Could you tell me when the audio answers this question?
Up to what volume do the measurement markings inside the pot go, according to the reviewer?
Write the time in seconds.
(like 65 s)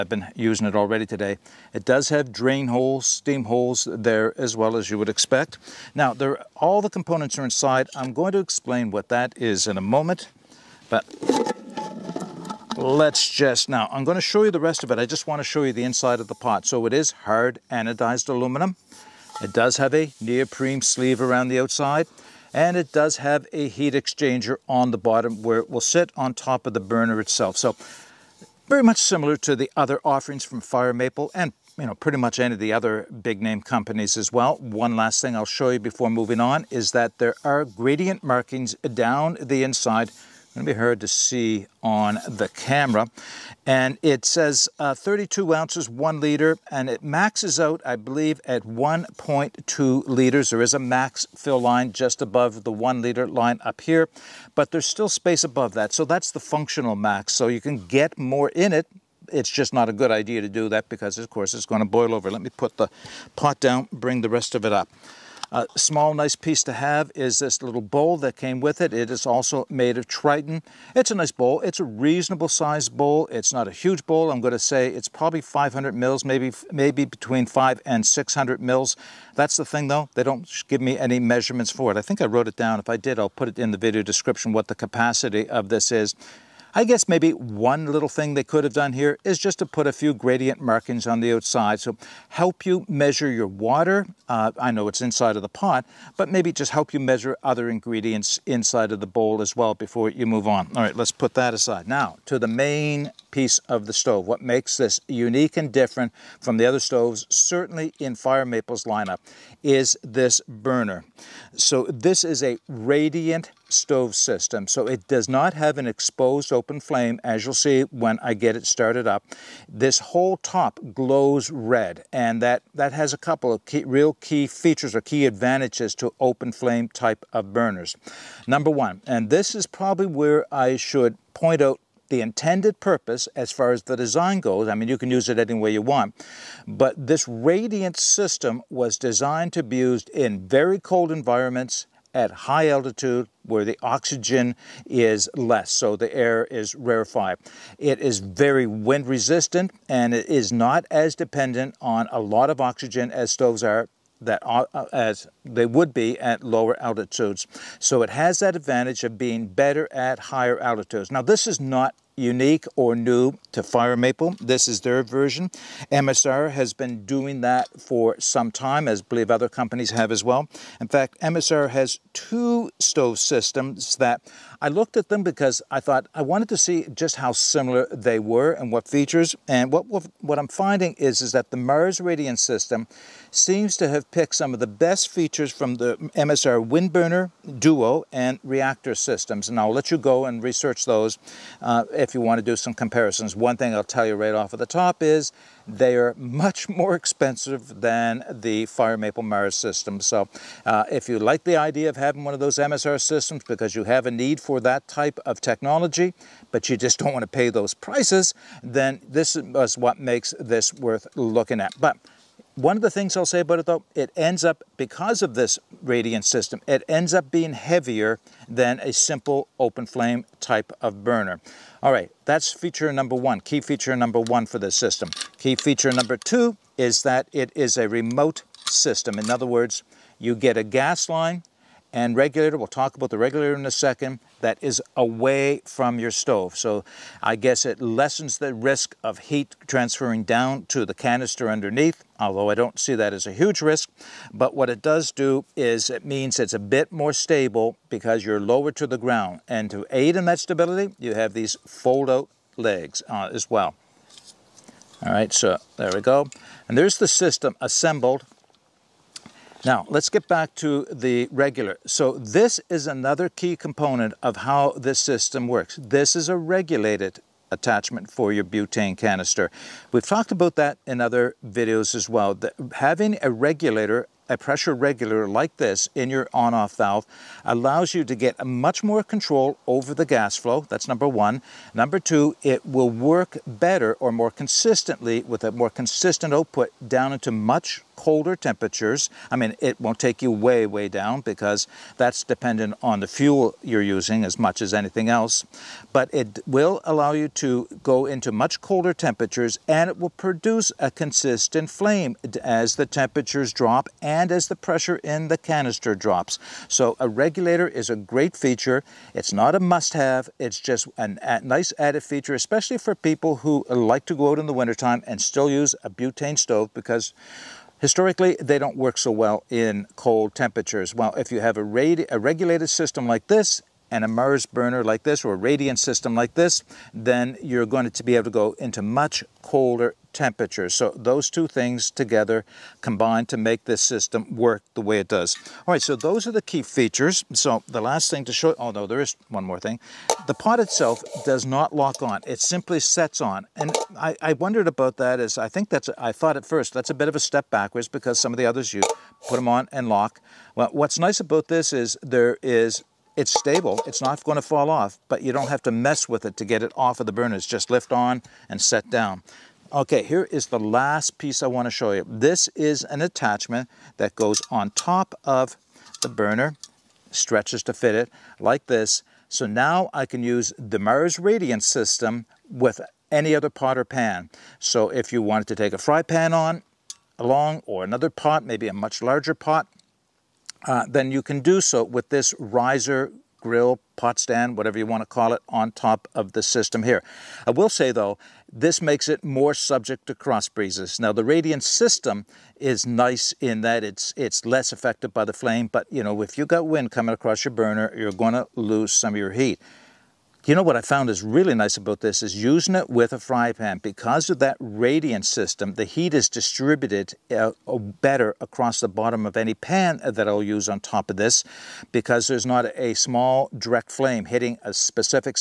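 48 s.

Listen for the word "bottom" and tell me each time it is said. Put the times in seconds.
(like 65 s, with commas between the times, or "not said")
24 s, 408 s.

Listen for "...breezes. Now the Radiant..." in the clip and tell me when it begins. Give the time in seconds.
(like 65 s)
390 s.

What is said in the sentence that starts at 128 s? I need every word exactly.
Number one, and this is probably where I should point out the intended purpose as far as the design goes.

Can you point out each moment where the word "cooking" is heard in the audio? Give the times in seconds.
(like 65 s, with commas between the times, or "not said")
not said.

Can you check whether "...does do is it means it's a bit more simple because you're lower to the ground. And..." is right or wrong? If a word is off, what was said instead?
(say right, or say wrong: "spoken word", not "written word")
wrong: "stable", not "simple".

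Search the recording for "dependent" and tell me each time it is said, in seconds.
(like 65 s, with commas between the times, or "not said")
151 s, 292 s.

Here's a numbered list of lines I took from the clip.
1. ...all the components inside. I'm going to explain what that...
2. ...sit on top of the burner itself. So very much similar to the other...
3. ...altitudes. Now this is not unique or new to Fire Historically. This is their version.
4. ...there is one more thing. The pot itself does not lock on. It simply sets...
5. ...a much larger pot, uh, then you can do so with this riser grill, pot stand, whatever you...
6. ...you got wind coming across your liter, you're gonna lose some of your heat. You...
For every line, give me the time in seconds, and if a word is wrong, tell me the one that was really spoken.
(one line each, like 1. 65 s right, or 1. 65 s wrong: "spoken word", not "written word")
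1. 6 s right
2. 25 s right
3. 160 s wrong: "Maple", not "Historically"
4. 338 s right
5. 378 s right
6. 396 s wrong: "burner", not "liter".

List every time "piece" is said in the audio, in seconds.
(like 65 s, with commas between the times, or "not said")
66 s, 103 s, 361 s.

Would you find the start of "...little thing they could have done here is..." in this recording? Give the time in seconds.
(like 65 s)
87 s.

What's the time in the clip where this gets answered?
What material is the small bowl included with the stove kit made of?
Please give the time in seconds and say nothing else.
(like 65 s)
70 s.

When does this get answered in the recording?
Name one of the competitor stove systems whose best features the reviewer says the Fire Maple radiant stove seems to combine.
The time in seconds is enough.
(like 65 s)
188 s.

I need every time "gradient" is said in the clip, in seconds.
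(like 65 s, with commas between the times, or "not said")
37 s, 90 s.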